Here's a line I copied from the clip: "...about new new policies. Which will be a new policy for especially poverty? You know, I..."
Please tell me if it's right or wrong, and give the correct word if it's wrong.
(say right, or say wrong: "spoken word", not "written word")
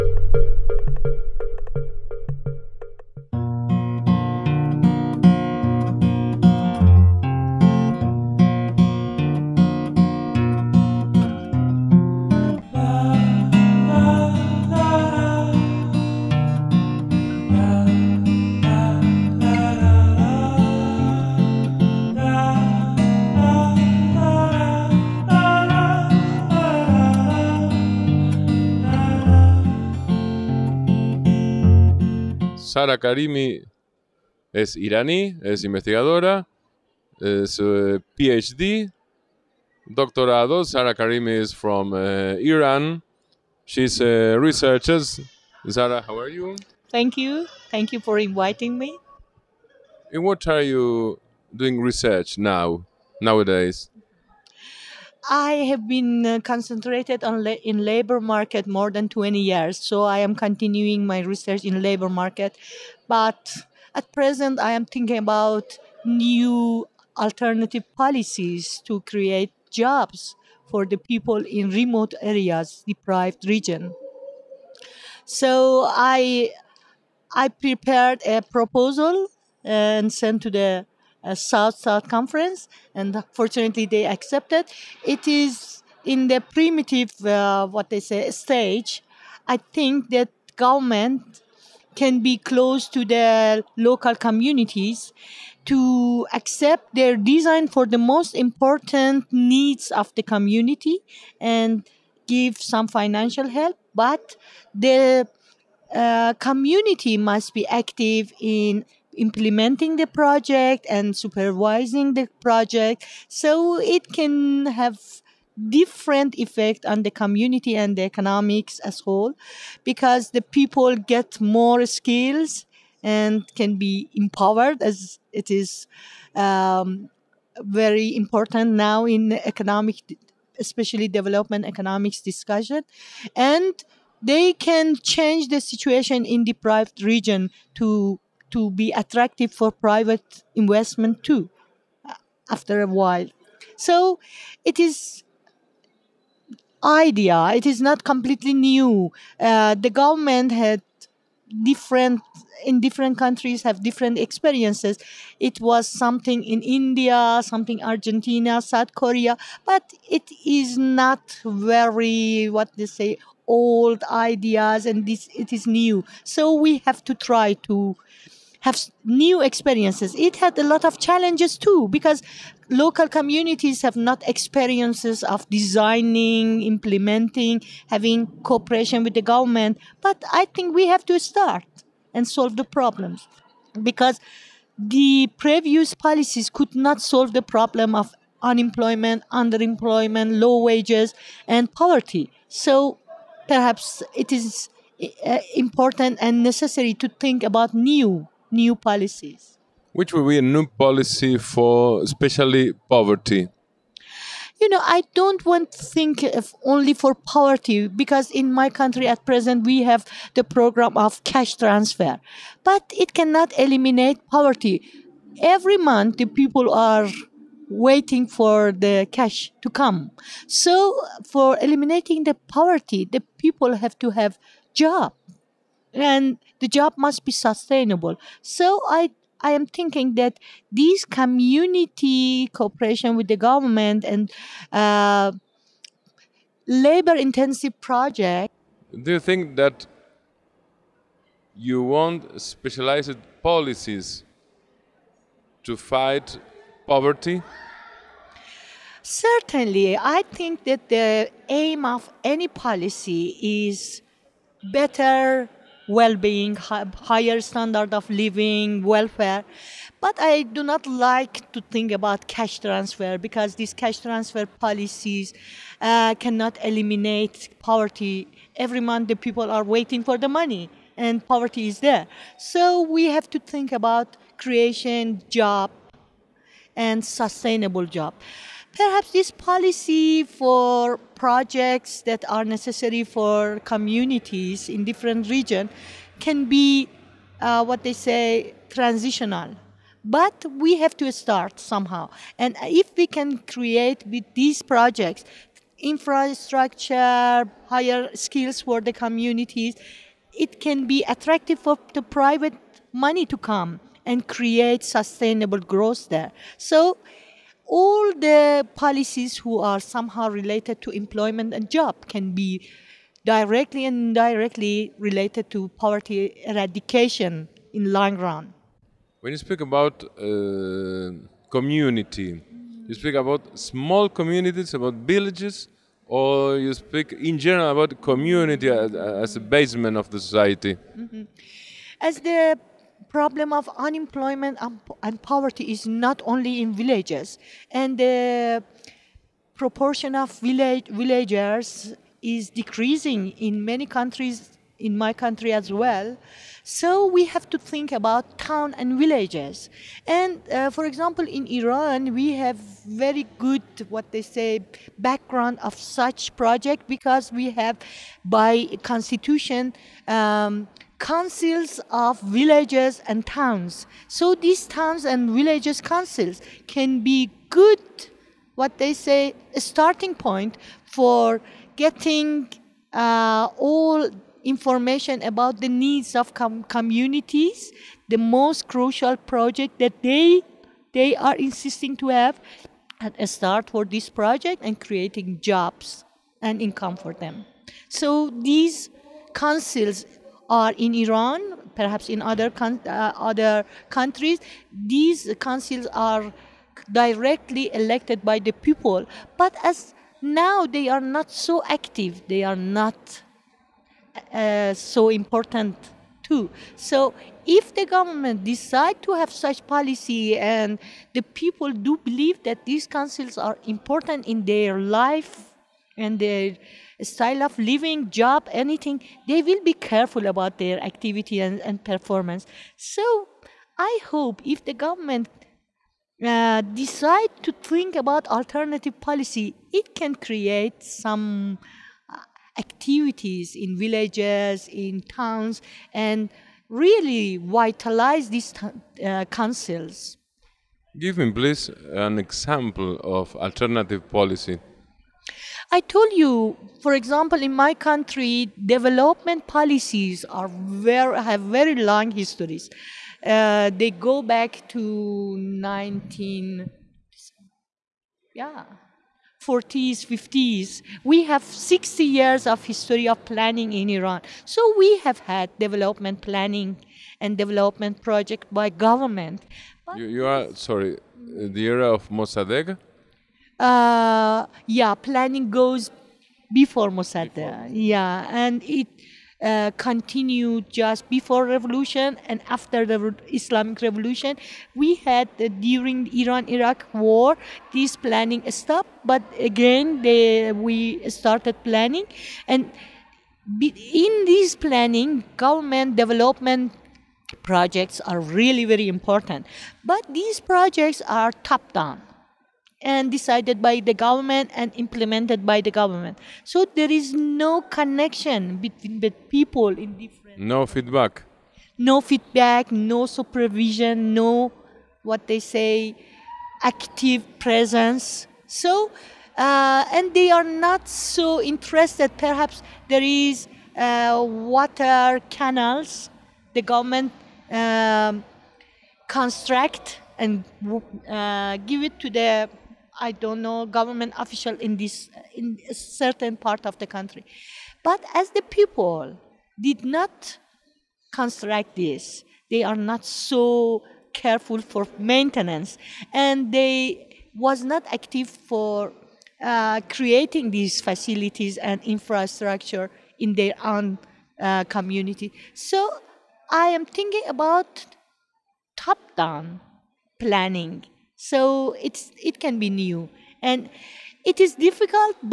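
right.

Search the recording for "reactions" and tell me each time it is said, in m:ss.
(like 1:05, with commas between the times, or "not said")
not said.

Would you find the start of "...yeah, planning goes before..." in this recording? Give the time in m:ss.
7:54.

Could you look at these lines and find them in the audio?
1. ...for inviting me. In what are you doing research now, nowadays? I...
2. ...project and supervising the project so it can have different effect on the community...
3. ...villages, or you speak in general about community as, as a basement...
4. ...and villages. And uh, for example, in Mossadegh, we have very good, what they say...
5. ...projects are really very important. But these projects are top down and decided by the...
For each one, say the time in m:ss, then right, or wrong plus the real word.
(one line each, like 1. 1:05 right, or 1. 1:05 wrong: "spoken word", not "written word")
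1. 0:48 right
2. 1:50 right
3. 5:24 right
4. 5:48 wrong: "Iran", not "Mossadegh"
5. 8:17 right.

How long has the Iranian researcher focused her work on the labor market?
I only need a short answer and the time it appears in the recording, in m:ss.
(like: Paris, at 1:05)
more than 20 years, at 0:58.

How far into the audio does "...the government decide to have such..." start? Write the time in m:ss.
6:47.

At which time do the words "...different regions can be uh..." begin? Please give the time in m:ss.
4:44.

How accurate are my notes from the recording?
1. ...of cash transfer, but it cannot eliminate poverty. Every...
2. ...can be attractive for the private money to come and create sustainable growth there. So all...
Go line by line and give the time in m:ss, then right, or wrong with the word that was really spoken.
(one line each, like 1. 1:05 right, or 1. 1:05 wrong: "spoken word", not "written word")
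1. 3:30 right
2. 5:00 right.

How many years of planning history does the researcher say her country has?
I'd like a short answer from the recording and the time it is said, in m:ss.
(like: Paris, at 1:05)
60 years, at 7:41.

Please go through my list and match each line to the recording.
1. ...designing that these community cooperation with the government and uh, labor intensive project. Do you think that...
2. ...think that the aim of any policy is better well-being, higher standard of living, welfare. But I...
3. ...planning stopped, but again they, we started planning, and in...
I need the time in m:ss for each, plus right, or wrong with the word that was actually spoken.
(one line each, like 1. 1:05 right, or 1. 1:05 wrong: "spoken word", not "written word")
1. 3:49 wrong: "thinking", not "designing"
2. 4:10 right
3. 8:07 right.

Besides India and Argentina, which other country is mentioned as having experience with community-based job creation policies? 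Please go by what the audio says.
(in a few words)
South Korea.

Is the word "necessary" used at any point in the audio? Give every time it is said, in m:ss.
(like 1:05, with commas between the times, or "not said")
3:16, 4:42.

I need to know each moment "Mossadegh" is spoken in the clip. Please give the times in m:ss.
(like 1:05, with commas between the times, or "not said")
7:52, 7:56.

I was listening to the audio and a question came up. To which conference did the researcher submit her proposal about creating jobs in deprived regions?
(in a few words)
South South Conference.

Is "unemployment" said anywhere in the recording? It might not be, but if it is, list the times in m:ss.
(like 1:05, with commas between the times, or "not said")
3:08, 5:33.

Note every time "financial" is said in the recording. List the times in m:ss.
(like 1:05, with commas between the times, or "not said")
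1:42.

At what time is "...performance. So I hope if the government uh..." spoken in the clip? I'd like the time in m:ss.
7:01.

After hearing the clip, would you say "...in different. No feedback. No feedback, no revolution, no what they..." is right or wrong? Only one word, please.
wrong.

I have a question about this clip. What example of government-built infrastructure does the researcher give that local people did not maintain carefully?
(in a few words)
water canals.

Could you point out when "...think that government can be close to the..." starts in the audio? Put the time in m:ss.
1:29.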